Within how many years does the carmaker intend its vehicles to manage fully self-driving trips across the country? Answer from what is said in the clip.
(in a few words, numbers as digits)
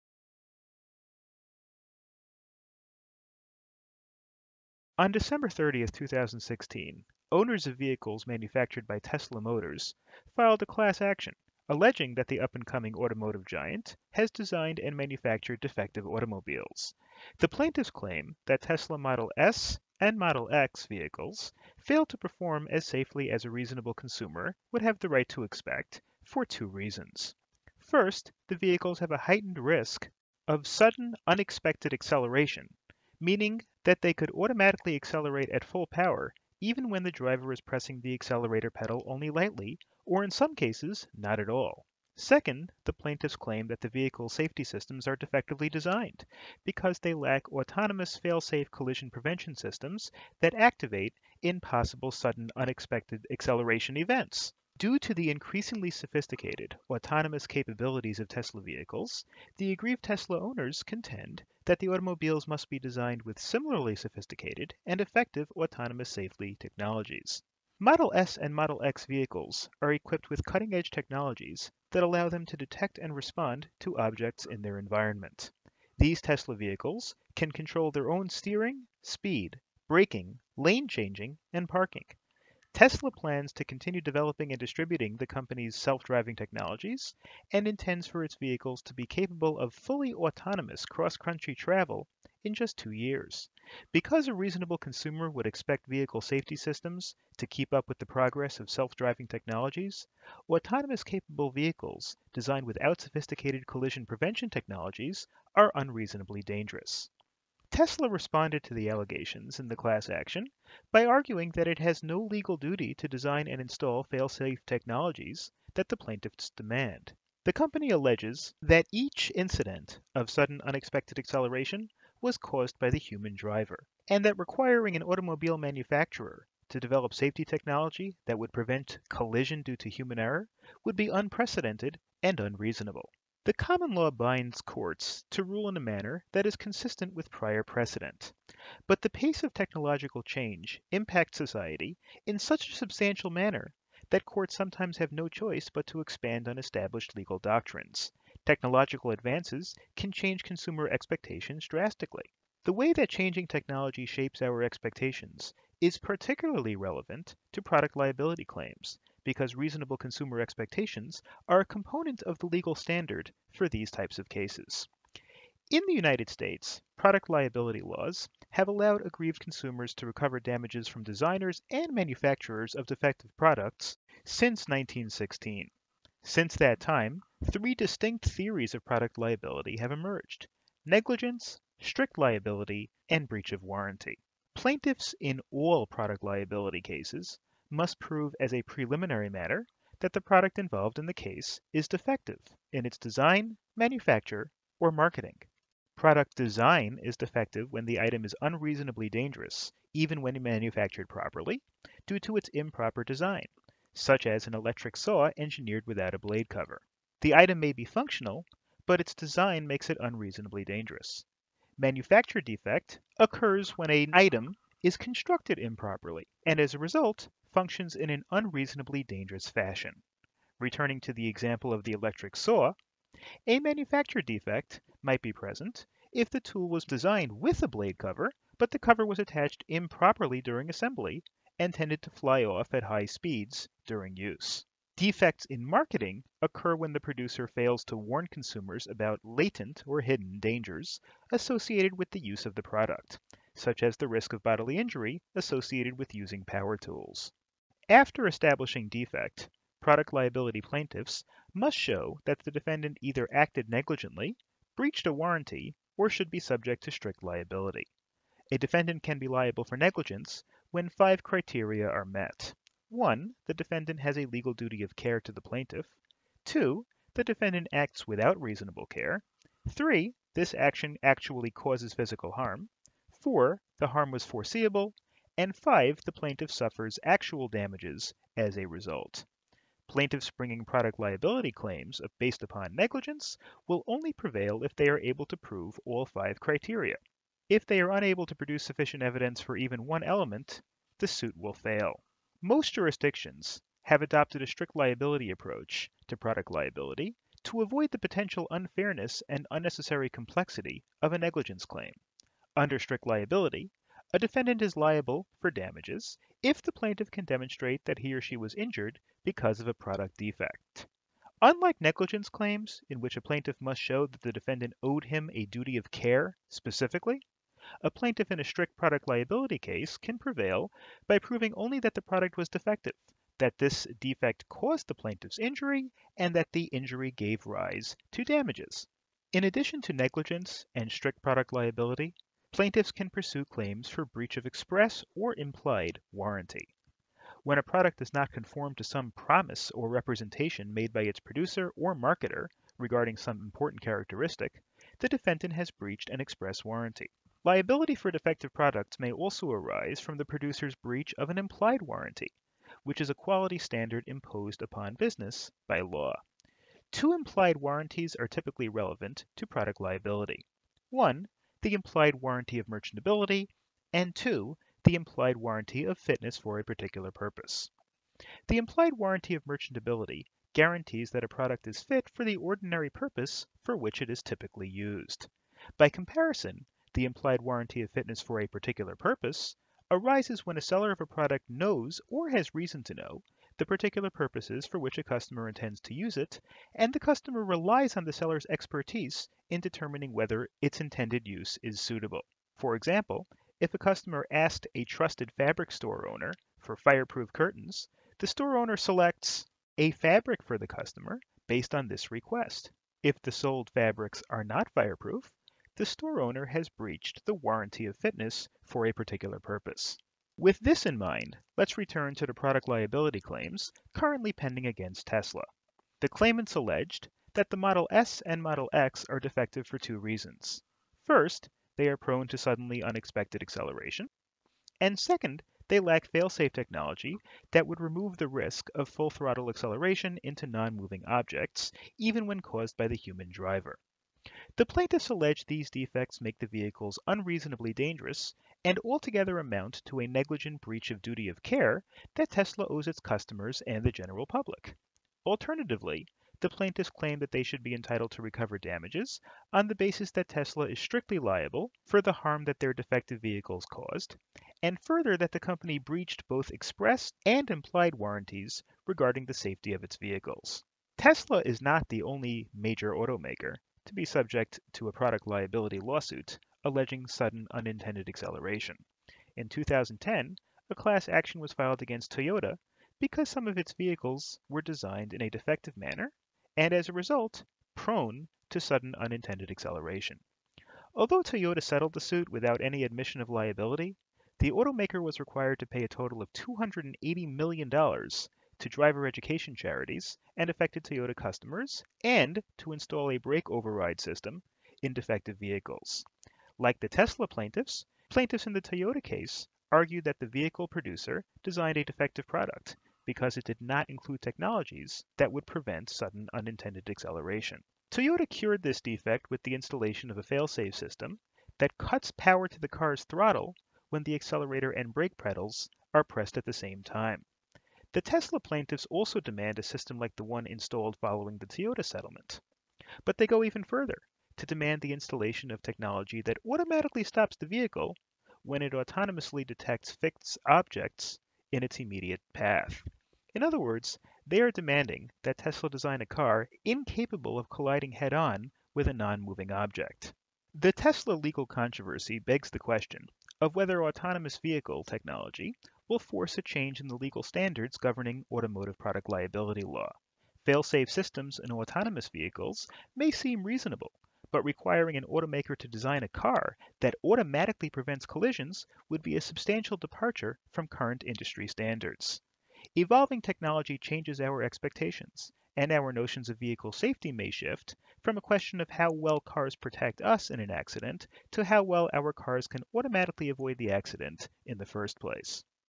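2 years.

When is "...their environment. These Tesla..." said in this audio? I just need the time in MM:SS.
01:14.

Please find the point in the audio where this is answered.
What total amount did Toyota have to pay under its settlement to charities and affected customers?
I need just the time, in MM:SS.
08:06.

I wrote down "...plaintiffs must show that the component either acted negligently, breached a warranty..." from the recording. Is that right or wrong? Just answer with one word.
wrong.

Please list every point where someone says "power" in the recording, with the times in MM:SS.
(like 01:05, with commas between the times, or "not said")
00:35, 04:06, 08:32.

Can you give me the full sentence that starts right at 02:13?
The common law binds courts to rule in a manner that is consistent with prior precedent.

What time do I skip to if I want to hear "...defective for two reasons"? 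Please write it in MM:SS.
06:59.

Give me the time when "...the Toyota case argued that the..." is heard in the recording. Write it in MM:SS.
08:18.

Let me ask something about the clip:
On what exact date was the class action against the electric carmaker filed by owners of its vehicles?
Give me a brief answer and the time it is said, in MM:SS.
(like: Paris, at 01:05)
December 30, 2016, at 00:05.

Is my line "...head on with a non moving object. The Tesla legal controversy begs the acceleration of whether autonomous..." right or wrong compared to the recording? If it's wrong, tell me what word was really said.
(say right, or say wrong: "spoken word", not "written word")
wrong: "question", not "acceleration".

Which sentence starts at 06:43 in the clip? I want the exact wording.
If the sold fabrics are not fireproof, the store owner has breached the warranty of fitness for a particular purpose.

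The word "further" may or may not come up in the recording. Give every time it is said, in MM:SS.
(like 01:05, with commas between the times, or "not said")
07:34, 08:43.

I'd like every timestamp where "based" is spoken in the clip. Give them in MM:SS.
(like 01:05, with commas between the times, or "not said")
04:42, 06:41.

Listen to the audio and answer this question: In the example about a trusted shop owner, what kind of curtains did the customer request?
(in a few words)
fireproof curtains.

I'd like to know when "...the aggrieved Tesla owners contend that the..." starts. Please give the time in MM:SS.
00:59.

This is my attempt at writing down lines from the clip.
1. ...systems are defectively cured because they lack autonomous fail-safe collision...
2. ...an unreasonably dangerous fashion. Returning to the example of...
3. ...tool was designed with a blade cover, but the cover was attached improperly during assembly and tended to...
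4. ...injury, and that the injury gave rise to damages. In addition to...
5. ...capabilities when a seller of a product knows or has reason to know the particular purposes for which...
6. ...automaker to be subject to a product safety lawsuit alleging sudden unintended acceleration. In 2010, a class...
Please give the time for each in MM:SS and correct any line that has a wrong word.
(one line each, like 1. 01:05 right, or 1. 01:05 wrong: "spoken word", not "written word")
1. 00:44 wrong: "designed", not "cured"
2. 03:38 right
3. 03:46 right
4. 05:25 right
5. 06:19 wrong: "arises", not "capabilities"
6. 07:42 wrong: "liability", not "safety".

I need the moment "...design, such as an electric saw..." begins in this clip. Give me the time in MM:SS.
03:23.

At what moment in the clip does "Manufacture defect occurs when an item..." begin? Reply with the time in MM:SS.
03:31.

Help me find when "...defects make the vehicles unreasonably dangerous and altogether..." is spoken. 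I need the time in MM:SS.
07:15.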